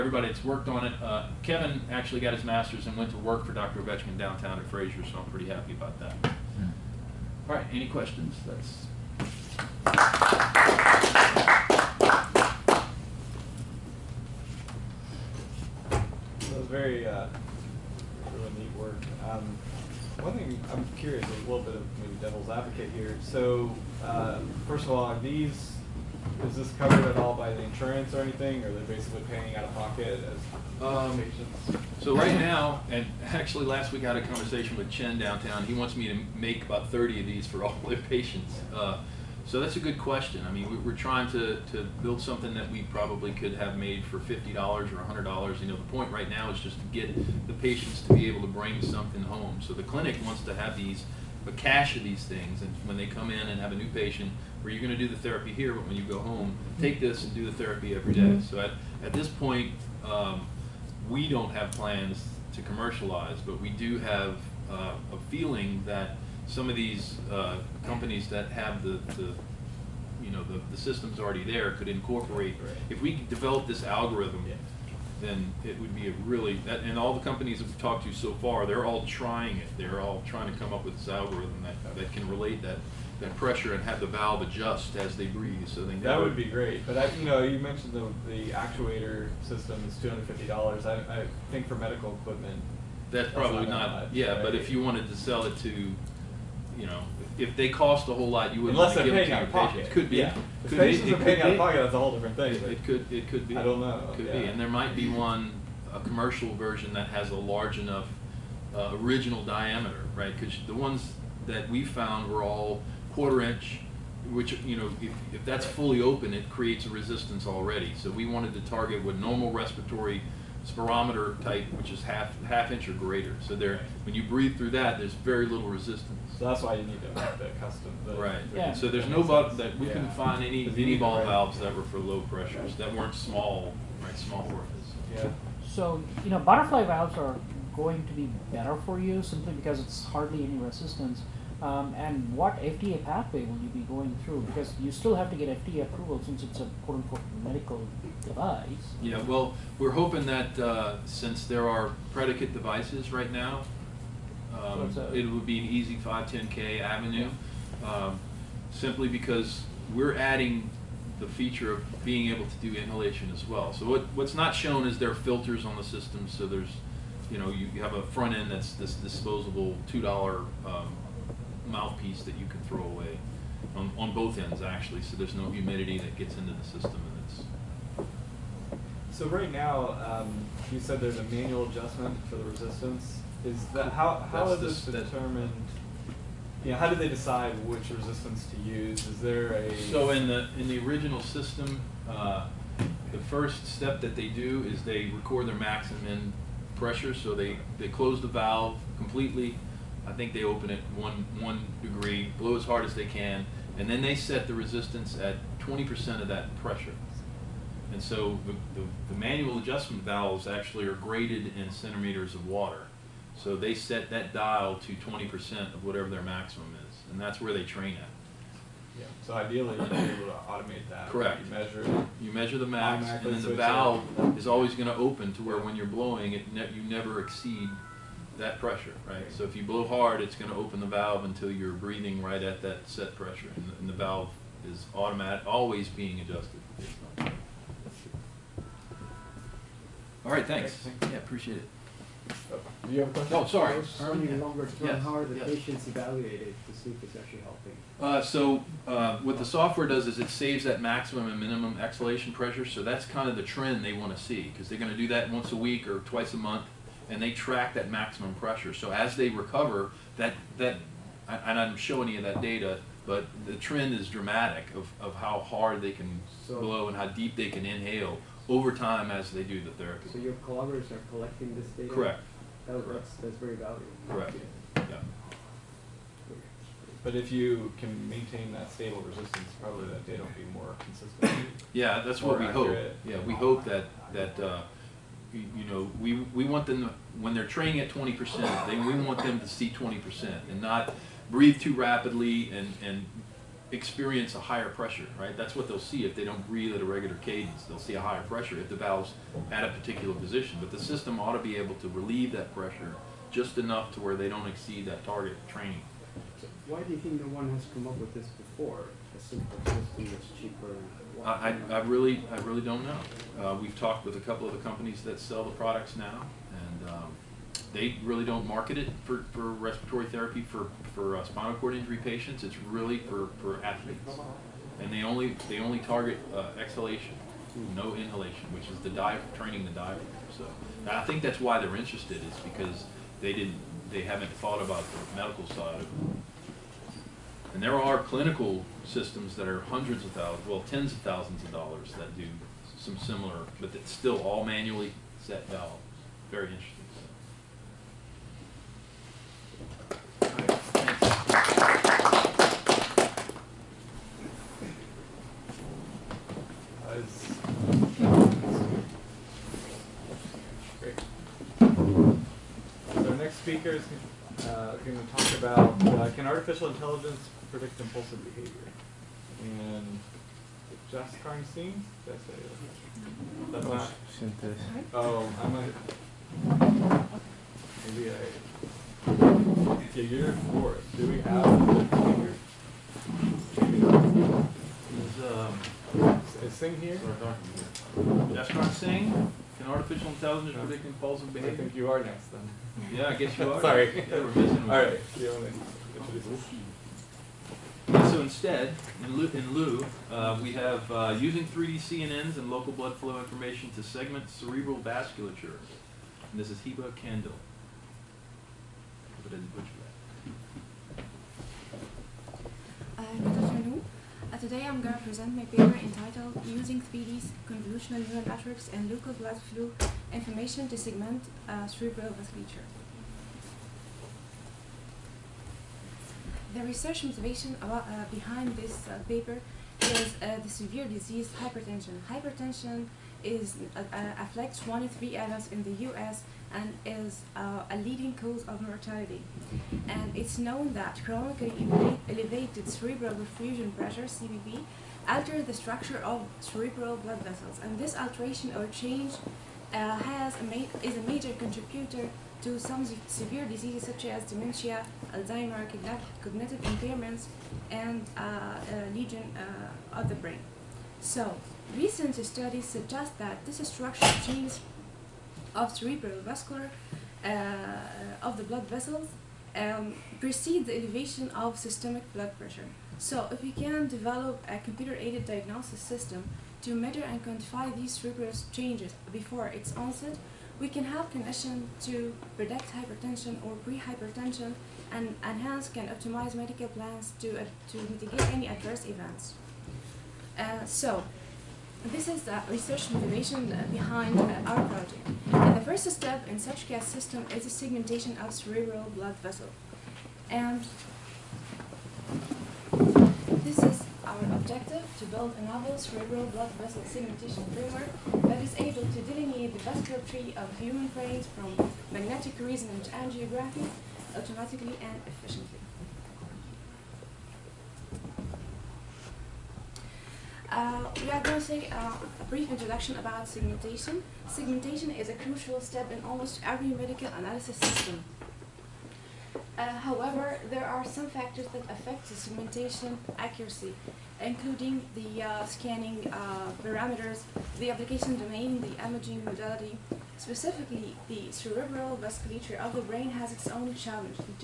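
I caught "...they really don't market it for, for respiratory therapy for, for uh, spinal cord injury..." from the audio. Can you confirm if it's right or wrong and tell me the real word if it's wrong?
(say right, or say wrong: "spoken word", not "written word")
right.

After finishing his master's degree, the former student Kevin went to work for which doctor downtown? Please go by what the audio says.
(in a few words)
Dr. Ovechkin.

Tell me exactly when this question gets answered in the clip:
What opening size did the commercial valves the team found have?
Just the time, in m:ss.
1:53.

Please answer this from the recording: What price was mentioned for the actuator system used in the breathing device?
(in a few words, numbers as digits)
$250.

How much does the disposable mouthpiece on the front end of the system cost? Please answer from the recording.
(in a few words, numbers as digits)
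$2.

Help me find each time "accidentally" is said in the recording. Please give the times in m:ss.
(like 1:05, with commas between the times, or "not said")
not said.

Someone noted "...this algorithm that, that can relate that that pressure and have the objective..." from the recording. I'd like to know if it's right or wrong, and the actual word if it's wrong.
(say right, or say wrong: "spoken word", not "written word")
wrong: "valve", not "objective".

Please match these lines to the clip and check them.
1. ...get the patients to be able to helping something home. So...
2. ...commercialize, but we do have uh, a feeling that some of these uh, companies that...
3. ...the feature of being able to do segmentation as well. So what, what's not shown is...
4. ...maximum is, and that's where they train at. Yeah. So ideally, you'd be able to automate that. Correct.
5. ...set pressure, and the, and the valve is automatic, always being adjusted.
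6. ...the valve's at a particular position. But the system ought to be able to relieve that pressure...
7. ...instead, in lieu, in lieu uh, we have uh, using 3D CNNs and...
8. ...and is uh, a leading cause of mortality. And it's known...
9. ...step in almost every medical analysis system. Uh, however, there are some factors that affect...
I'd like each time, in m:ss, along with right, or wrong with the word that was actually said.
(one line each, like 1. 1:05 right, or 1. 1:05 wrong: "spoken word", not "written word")
1. 0:46 wrong: "bring", not "helping"
2. 1:02 right
3. 2:41 wrong: "inhalation", not "segmentation"
4. 3:36 right
5. 3:52 right
6. 4:58 right
7. 6:38 right
8. 7:16 right
9. 8:45 right.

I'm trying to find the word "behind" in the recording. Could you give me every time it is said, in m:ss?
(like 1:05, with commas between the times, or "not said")
7:08, 8:13.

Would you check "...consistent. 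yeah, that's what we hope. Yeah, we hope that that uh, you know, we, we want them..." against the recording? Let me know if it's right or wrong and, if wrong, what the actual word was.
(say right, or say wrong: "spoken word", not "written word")
right.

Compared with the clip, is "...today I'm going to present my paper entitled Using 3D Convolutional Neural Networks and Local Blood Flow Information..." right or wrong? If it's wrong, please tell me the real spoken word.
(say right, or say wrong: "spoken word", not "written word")
right.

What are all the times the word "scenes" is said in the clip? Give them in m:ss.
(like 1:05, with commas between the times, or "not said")
6:11.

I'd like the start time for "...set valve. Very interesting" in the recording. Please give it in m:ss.
5:45.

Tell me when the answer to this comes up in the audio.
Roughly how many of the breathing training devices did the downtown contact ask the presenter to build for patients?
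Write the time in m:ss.
0:36.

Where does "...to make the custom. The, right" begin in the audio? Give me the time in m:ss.
2:07.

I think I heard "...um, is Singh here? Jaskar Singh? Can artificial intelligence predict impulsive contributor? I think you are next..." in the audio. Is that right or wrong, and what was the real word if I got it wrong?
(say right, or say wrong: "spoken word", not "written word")
wrong: "behavior", not "contributor".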